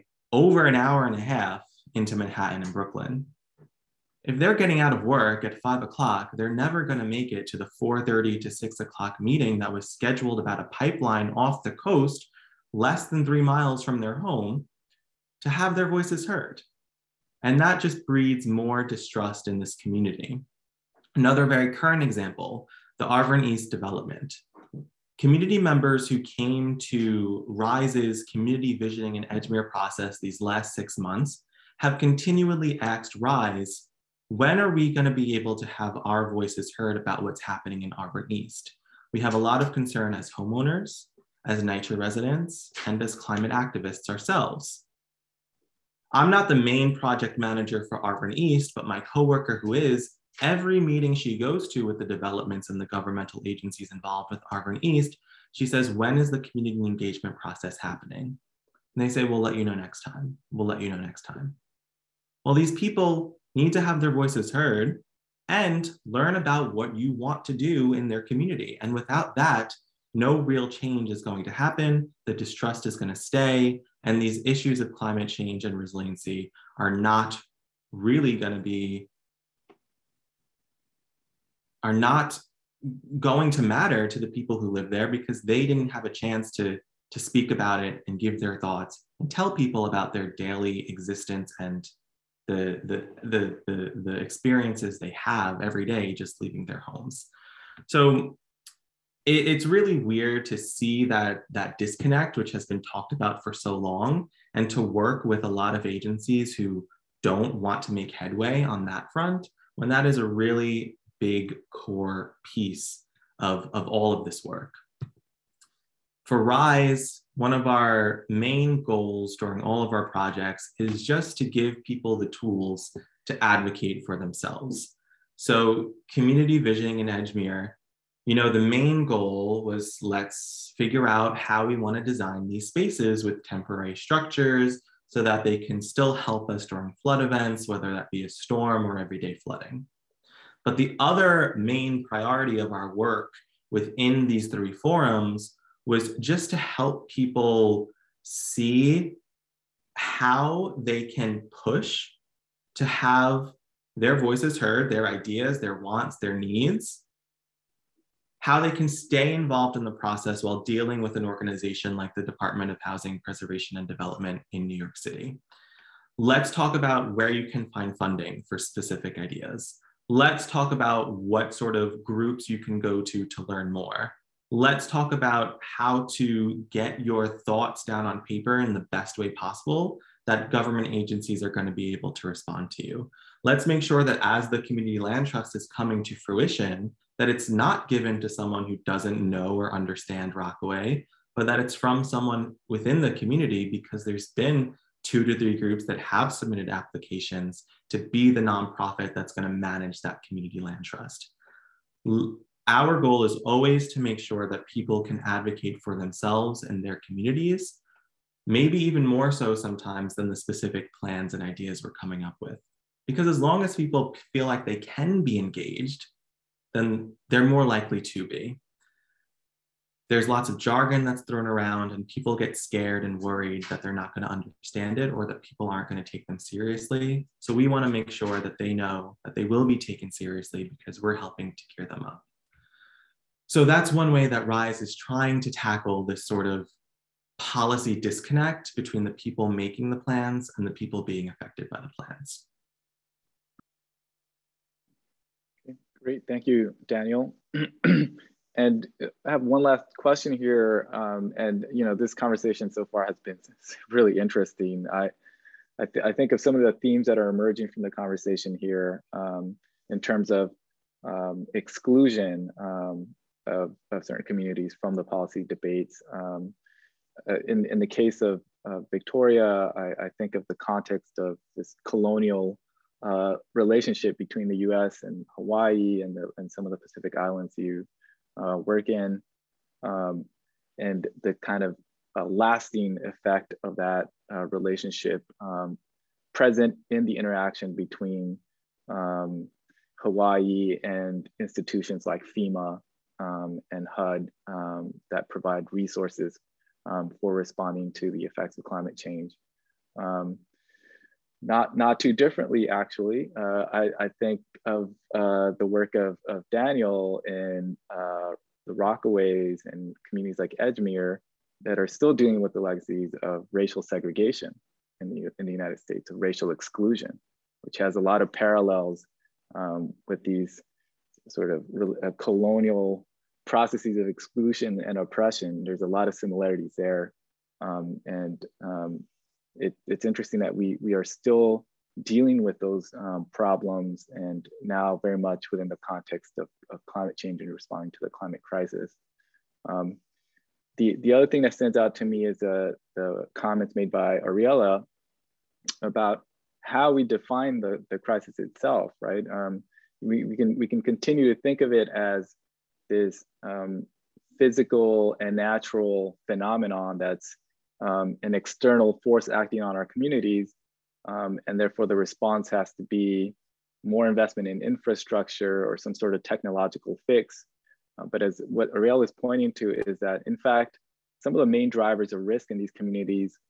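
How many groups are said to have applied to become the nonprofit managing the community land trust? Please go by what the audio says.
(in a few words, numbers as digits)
2 to 3.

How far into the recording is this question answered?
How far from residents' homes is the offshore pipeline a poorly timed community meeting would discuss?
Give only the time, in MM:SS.
00:12.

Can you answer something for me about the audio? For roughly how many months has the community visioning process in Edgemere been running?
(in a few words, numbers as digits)
6 months.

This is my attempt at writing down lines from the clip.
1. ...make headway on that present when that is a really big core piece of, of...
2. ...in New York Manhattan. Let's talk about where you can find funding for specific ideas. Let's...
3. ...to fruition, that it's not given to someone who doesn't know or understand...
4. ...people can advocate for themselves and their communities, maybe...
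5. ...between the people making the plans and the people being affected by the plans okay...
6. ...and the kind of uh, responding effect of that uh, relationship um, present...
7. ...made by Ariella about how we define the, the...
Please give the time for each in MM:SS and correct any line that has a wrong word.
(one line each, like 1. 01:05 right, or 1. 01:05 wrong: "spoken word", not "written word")
1. 01:47 wrong: "front", not "present"
2. 02:44 wrong: "City", not "Manhattan"
3. 03:06 right
4. 03:24 right
5. 03:58 right
6. 04:40 wrong: "lasting", not "responding"
7. 05:43 right.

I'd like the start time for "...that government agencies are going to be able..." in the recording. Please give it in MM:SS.
03:00.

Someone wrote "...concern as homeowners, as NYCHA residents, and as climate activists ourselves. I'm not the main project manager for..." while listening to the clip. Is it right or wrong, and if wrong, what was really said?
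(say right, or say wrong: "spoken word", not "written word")
right.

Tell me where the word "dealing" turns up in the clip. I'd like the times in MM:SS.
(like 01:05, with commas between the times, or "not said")
02:40, 05:12, 05:32.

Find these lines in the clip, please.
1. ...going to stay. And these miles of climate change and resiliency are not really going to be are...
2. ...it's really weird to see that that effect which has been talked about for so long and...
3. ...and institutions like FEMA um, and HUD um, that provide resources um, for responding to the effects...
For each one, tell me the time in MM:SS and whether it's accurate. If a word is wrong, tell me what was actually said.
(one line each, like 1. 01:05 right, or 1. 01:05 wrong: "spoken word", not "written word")
1. 01:12 wrong: "issues", not "miles"
2. 01:39 wrong: "disconnect", not "effect"
3. 04:50 right.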